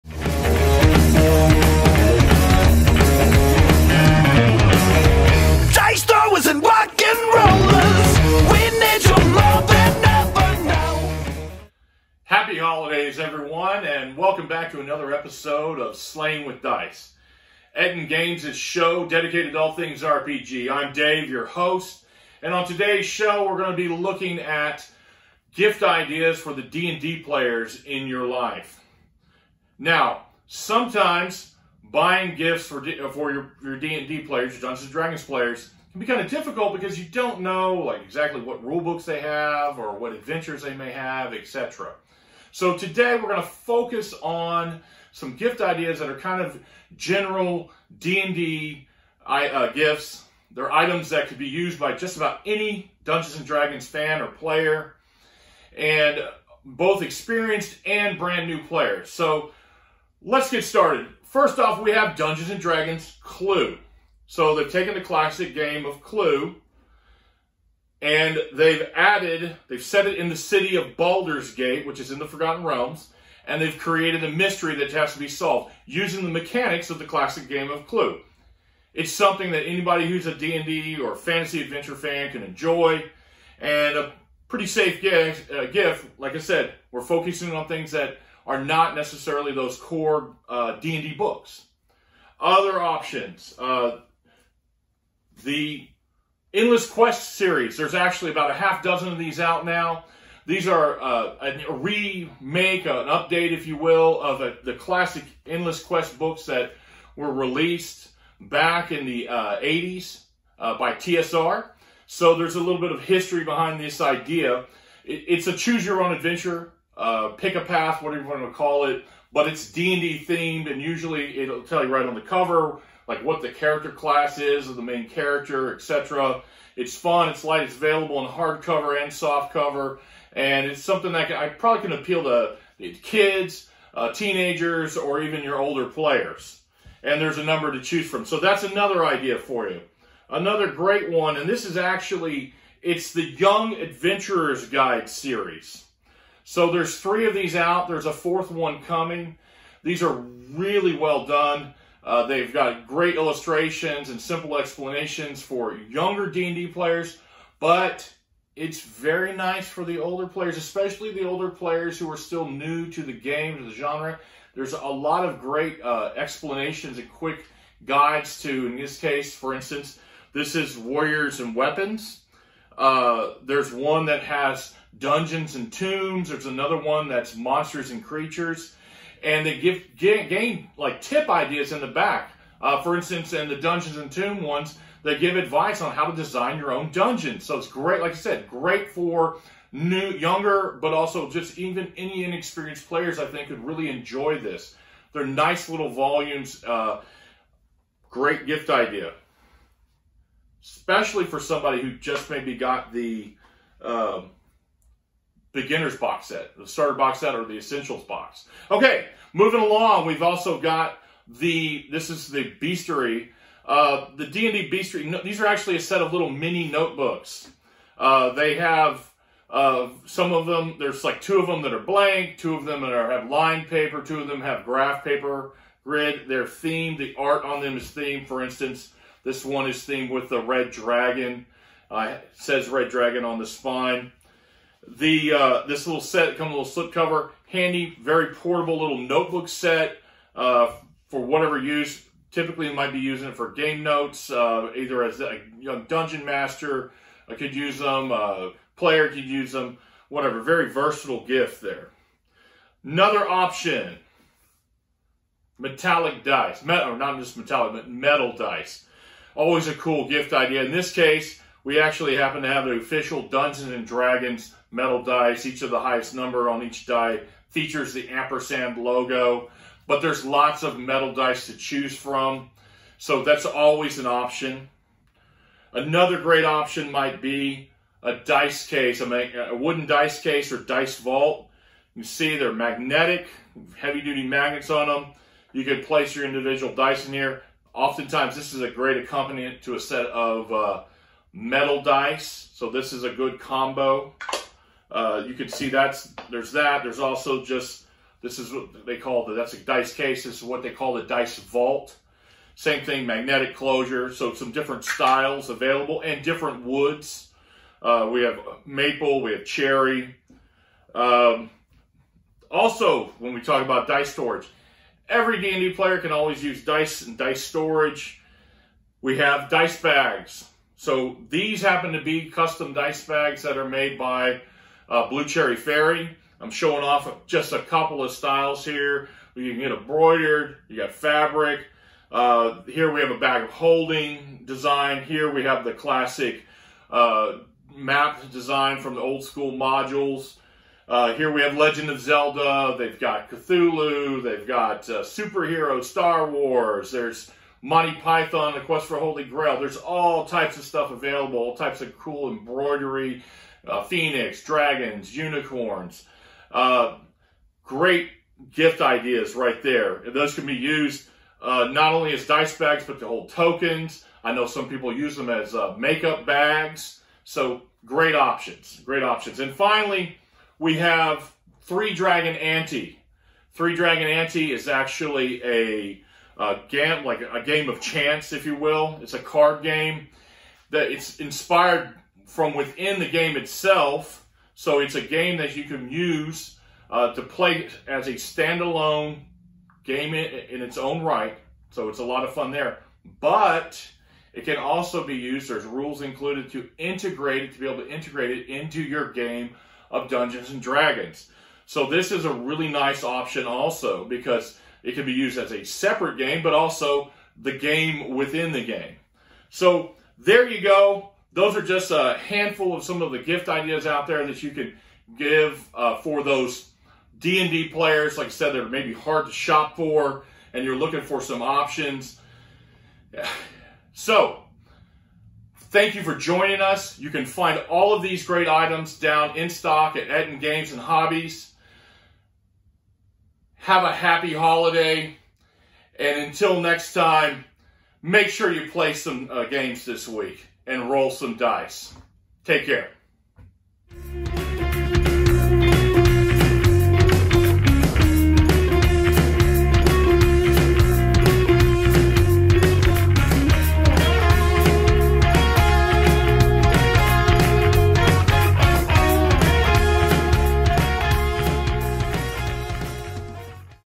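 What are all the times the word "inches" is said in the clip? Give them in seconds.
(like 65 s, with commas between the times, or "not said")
not said.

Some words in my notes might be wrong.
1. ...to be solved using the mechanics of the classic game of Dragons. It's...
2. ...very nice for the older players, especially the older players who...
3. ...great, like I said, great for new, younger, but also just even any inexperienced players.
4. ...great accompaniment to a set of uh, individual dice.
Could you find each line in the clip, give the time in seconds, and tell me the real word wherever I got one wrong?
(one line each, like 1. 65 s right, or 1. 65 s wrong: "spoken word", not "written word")
1. 75 s wrong: "Clue", not "Dragons"
2. 158 s right
3. 187 s right
4. 288 s wrong: "metal", not "individual".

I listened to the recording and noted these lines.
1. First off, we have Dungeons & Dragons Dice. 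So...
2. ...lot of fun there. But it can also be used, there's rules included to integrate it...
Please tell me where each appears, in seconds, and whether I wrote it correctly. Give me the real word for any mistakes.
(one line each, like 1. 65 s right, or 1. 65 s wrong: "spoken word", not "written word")
1. 61 s wrong: "Clue", not "Dice"
2. 392 s right.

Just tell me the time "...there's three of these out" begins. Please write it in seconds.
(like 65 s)
146 s.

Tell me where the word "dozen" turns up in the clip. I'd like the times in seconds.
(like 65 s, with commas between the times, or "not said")
98 s.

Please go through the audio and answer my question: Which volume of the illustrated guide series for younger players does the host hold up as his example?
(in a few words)
Warriors and Weapons.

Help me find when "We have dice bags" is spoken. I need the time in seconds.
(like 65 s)
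319 s.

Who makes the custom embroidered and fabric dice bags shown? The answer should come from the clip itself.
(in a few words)
Blue Cherry Fairy.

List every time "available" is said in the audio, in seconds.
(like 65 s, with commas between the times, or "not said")
127 s, 305 s, 350 s.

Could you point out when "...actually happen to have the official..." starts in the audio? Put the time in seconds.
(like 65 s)
261 s.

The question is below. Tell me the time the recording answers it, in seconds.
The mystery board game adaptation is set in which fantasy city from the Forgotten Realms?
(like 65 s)
70 s.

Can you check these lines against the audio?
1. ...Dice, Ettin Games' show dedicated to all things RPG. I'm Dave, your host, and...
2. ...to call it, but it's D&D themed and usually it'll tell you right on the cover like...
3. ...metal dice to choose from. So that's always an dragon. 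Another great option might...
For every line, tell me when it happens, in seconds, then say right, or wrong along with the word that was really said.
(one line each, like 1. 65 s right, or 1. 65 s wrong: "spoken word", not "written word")
1. 16 s right
2. 118 s right
3. 270 s wrong: "option", not "dragon".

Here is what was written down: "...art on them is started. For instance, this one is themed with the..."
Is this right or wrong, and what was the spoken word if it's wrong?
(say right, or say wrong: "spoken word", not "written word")
wrong: "themed", not "started".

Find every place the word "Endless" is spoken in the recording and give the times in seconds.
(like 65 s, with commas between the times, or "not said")
96 s, 105 s.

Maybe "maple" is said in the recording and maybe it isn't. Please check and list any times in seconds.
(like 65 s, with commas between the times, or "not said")
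308 s.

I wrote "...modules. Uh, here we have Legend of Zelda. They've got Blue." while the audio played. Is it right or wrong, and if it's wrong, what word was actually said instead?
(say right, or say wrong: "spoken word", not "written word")
wrong: "Cthulhu", not "Blue".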